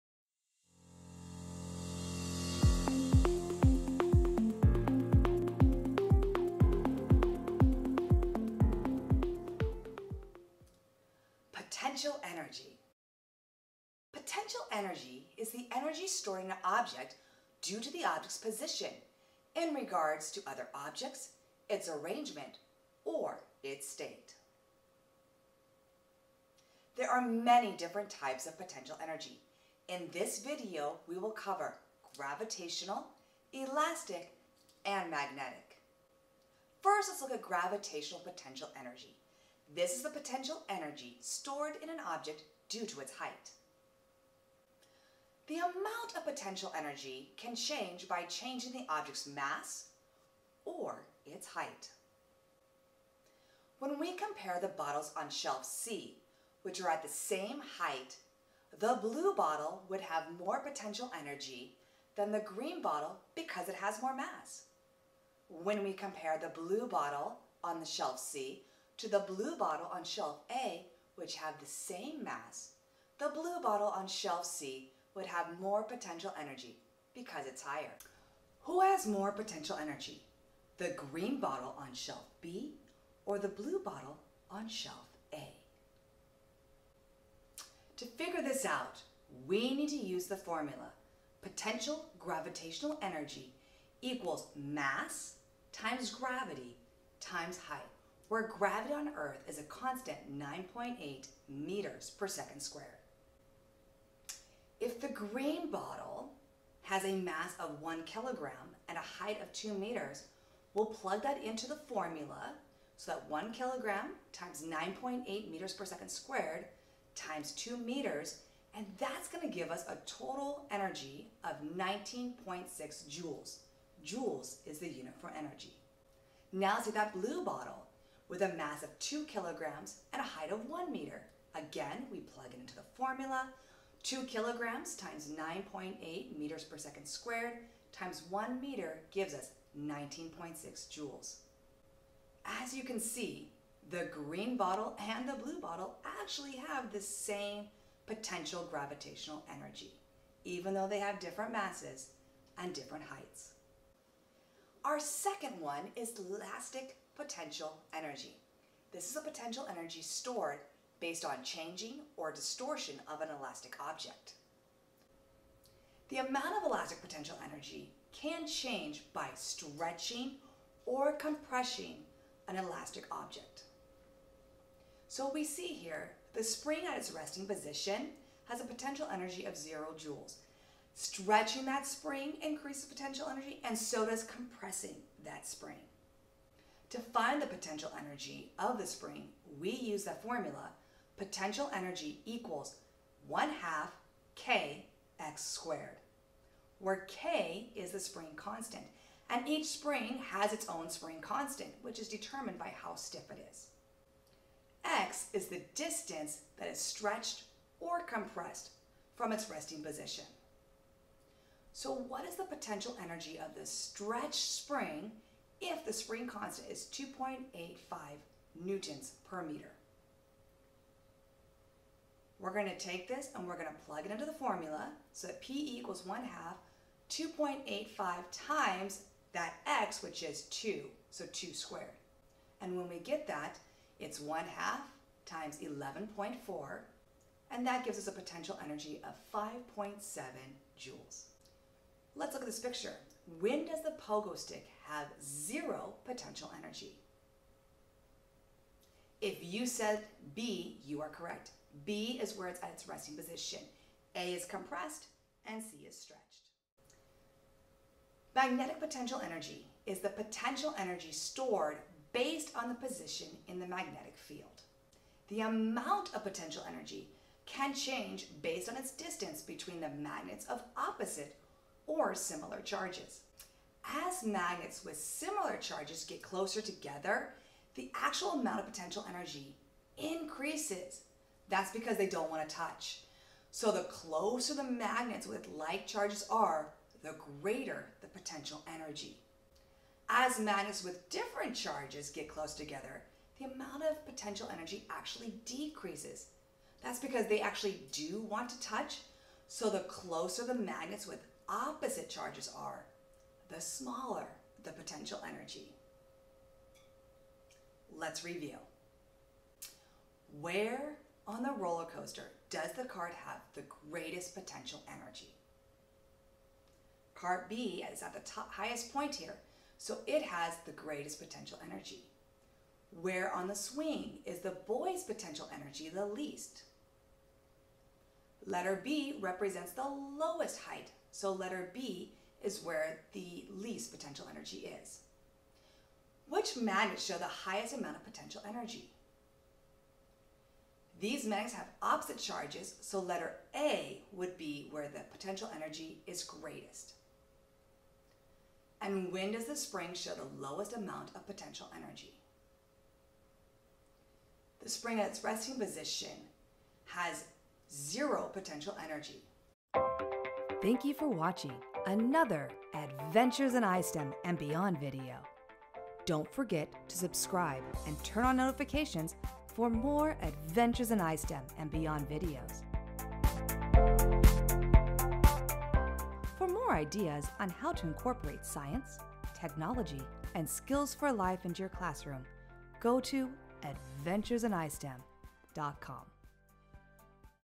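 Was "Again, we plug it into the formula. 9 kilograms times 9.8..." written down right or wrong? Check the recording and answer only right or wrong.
wrong.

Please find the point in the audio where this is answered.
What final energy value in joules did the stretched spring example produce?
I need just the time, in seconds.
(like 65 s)
239 s.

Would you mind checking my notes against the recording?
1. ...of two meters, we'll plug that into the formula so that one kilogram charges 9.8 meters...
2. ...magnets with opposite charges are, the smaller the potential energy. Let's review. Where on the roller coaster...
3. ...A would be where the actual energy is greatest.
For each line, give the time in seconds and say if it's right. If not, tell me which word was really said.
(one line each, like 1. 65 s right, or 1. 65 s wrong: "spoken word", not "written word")
1. 109 s wrong: "times", not "charges"
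2. 300 s right
3. 343 s wrong: "potential", not "actual".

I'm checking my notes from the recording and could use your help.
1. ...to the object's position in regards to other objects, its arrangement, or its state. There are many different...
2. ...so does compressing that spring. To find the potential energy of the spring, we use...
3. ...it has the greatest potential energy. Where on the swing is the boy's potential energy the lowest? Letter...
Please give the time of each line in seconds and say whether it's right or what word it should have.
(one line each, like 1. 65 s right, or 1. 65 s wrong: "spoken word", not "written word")
1. 17 s right
2. 183 s right
3. 320 s wrong: "least", not "lowest".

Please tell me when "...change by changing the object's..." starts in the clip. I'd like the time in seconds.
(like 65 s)
47 s.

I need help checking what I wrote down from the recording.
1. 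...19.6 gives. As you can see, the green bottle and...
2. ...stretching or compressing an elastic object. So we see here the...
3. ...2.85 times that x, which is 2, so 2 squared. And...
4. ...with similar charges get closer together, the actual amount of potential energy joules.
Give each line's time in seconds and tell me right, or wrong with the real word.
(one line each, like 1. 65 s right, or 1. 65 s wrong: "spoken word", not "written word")
1. 139 s wrong: "joules", not "gives"
2. 169 s right
3. 227 s right
4. 274 s wrong: "increases", not "joules".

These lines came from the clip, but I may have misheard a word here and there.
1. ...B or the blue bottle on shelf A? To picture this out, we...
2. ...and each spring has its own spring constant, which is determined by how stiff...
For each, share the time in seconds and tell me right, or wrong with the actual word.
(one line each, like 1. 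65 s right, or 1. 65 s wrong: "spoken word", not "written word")
1. 82 s wrong: "figure", not "picture"
2. 199 s right.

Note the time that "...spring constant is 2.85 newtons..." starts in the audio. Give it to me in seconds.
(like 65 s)
215 s.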